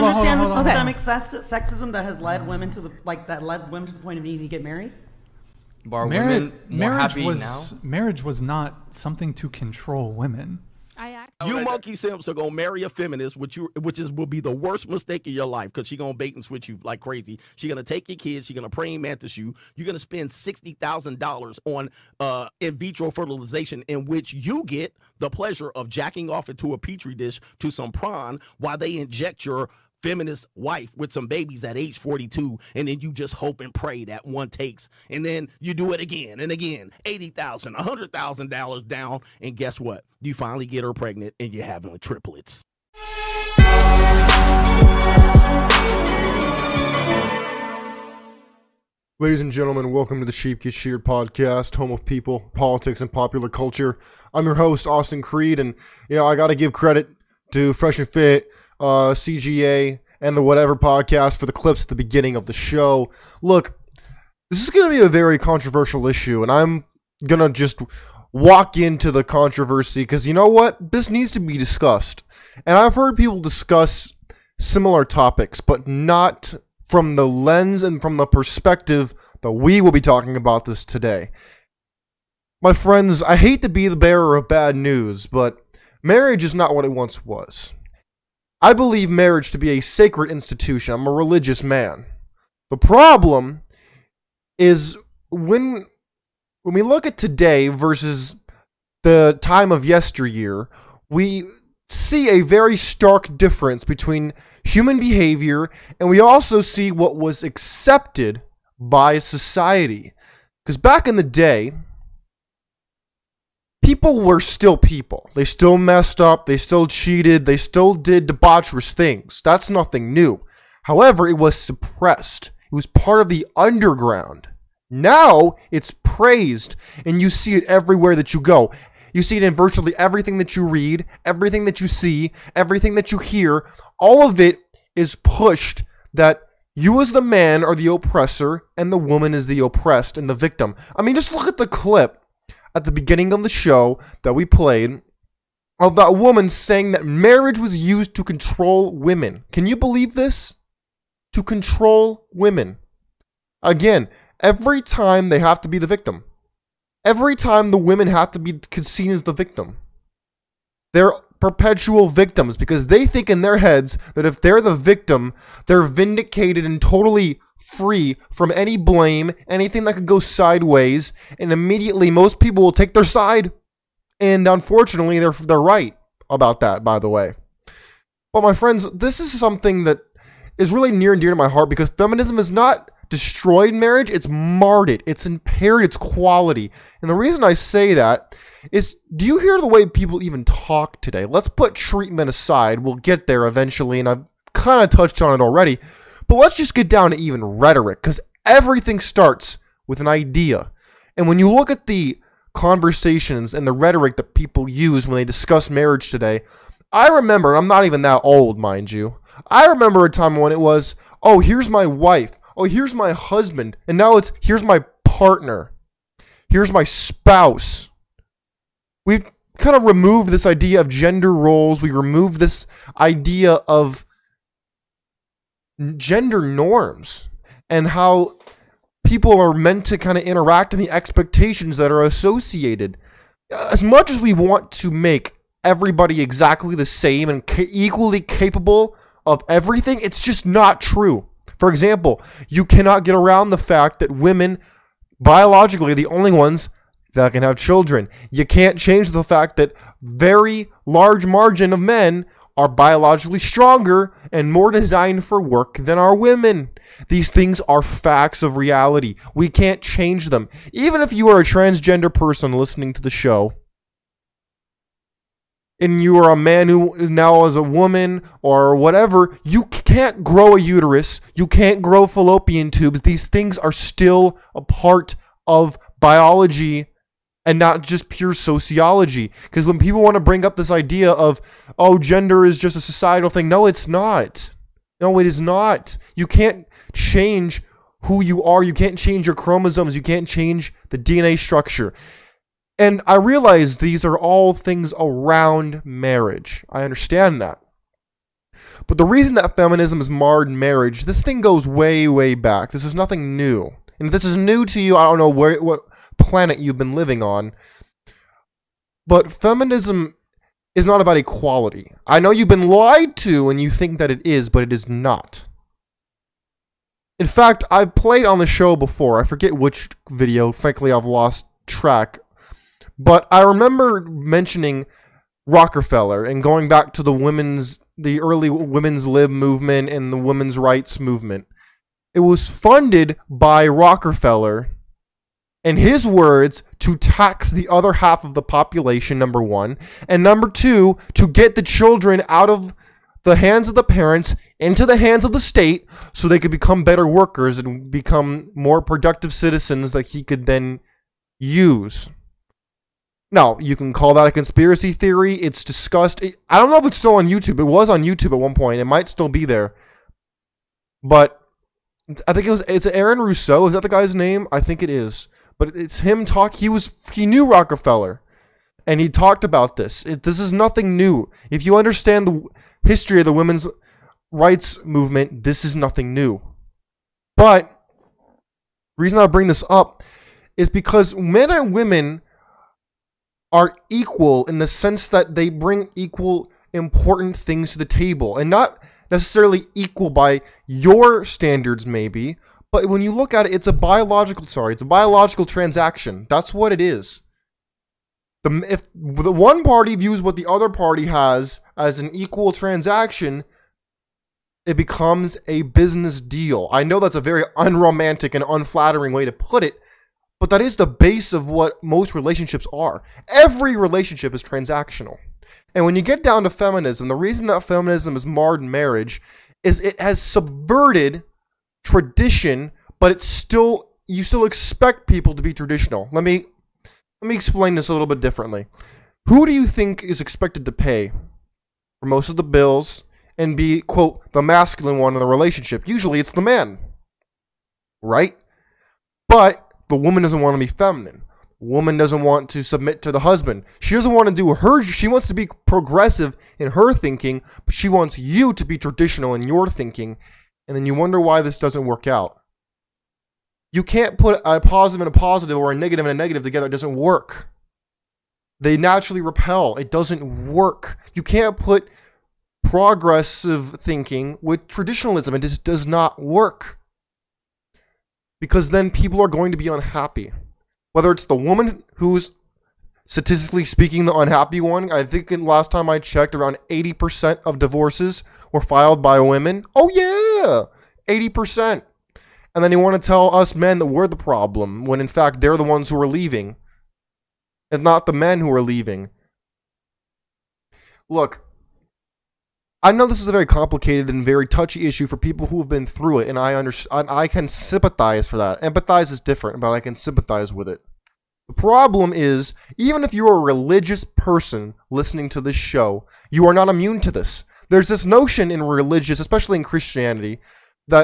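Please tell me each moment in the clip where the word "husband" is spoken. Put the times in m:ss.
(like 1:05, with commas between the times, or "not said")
3:33, 7:23.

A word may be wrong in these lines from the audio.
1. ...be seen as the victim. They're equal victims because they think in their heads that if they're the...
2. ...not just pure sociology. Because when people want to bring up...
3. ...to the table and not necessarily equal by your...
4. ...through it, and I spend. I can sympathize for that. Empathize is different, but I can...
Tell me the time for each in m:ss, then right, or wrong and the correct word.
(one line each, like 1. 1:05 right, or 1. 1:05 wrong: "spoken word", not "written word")
1. 2:38 wrong: "perpetual", not "equal"
2. 4:37 right
3. 6:27 right
4. 8:15 wrong: "understand", not "spend".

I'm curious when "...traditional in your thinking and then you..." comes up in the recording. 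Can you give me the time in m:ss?
7:28.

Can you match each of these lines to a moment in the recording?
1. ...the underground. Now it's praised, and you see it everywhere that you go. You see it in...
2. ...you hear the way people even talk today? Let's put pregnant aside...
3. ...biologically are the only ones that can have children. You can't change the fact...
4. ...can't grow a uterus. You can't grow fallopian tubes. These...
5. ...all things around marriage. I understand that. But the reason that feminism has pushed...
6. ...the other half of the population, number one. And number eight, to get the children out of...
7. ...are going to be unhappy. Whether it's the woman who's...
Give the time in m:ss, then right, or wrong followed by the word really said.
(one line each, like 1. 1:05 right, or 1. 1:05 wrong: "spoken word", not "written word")
1. 2:03 right
2. 3:09 wrong: "treatment", not "pregnant"
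3. 4:05 right
4. 4:29 right
5. 4:54 wrong: "marred", not "pushed"
6. 5:37 wrong: "two", not "eight"
7. 7:49 right.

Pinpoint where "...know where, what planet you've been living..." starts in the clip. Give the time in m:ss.
5:05.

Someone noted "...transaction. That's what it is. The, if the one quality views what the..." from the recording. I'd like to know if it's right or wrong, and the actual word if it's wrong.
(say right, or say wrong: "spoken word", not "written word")
wrong: "party", not "quality".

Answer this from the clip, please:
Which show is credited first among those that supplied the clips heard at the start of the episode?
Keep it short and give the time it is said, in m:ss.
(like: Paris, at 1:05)
Fresh and Fit, at 0:57.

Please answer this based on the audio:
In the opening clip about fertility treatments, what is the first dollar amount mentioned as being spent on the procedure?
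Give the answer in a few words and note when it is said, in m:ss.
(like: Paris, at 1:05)
$60,000, at 0:20.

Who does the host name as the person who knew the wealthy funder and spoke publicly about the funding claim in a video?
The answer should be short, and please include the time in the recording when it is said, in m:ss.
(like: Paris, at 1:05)
Aaron Russo, at 6:02.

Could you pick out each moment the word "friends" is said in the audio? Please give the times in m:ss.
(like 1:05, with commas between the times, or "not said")
1:22, 2:58.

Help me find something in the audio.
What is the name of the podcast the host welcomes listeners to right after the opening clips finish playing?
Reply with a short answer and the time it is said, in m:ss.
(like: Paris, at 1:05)
Sheep Get Sheared, at 0:50.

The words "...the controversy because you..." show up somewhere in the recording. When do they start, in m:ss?
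1:09.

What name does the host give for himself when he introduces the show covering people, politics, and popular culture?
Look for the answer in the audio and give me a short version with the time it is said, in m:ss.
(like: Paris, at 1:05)
Austin Creed, at 0:54.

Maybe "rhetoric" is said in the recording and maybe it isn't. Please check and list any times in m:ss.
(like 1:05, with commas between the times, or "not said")
3:17, 3:23.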